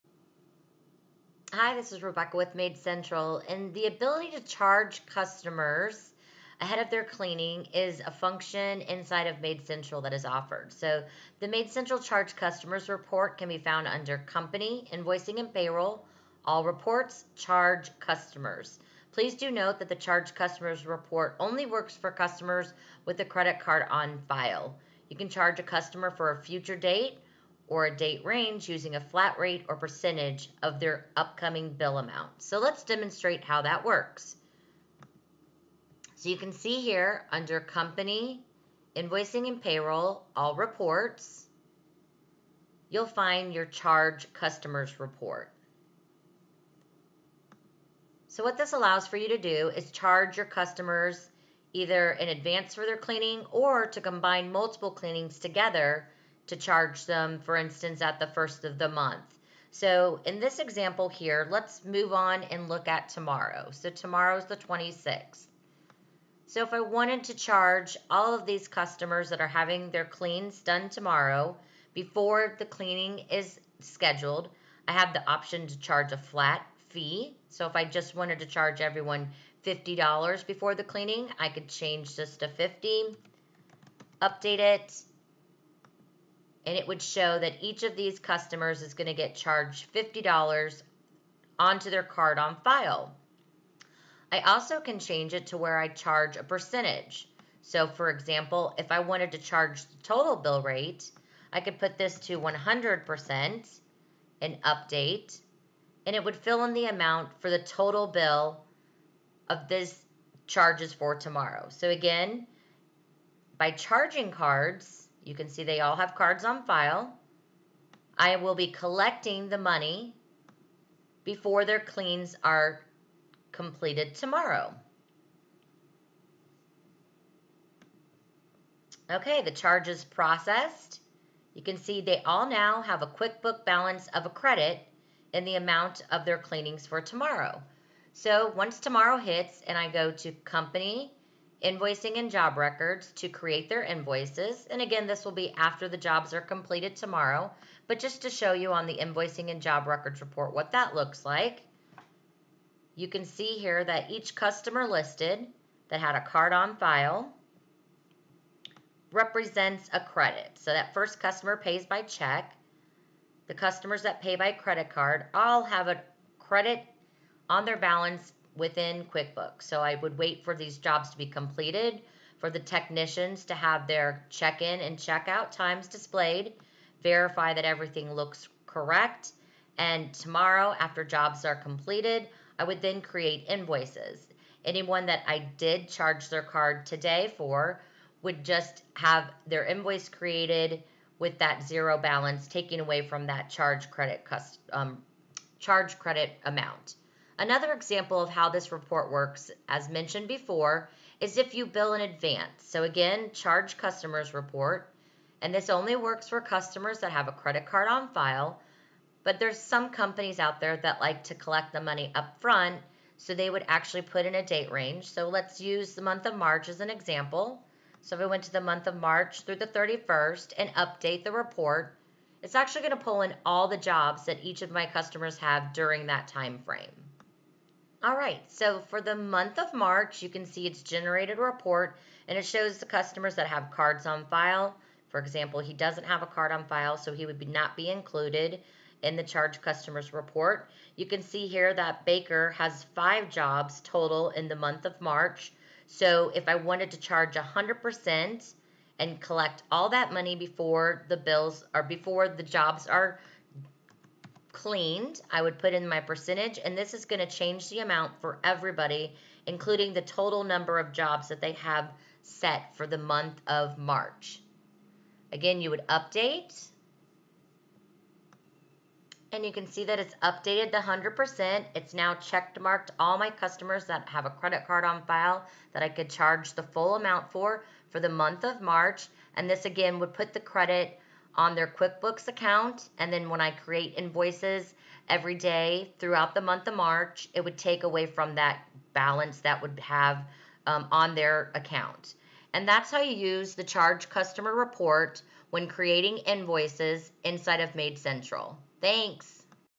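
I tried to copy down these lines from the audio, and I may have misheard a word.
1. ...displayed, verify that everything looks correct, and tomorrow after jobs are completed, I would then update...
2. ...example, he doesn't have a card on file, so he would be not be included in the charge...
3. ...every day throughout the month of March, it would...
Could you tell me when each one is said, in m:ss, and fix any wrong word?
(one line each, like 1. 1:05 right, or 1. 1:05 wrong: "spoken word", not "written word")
1. 2:55 wrong: "create", not "update"
2. 3:55 right
3. 4:45 right.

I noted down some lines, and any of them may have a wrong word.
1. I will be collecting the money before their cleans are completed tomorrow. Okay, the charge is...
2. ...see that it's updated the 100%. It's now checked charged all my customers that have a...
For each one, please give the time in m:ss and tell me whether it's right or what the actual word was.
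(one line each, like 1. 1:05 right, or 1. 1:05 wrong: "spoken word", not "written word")
1. 1:58 right
2. 4:29 wrong: "marked", not "charged".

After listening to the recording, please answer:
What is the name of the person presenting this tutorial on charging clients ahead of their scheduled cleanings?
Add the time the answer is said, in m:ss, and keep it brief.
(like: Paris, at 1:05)
Rebecca, at 0:02.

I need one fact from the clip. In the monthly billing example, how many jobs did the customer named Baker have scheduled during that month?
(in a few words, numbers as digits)
5.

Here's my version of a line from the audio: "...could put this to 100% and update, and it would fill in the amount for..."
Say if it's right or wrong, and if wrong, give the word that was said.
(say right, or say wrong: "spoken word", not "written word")
right.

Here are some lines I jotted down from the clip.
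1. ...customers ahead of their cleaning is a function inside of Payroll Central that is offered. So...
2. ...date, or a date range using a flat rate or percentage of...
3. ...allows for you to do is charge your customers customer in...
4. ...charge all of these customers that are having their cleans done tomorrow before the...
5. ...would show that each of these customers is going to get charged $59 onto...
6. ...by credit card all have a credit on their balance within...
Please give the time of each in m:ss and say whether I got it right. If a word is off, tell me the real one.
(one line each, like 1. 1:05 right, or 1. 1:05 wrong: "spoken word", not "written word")
1. 0:05 wrong: "Maid", not "Payroll"
2. 0:26 right
3. 0:48 wrong: "either", not "customer"
4. 1:07 right
5. 1:26 wrong: "50", not "59"
6. 2:44 right.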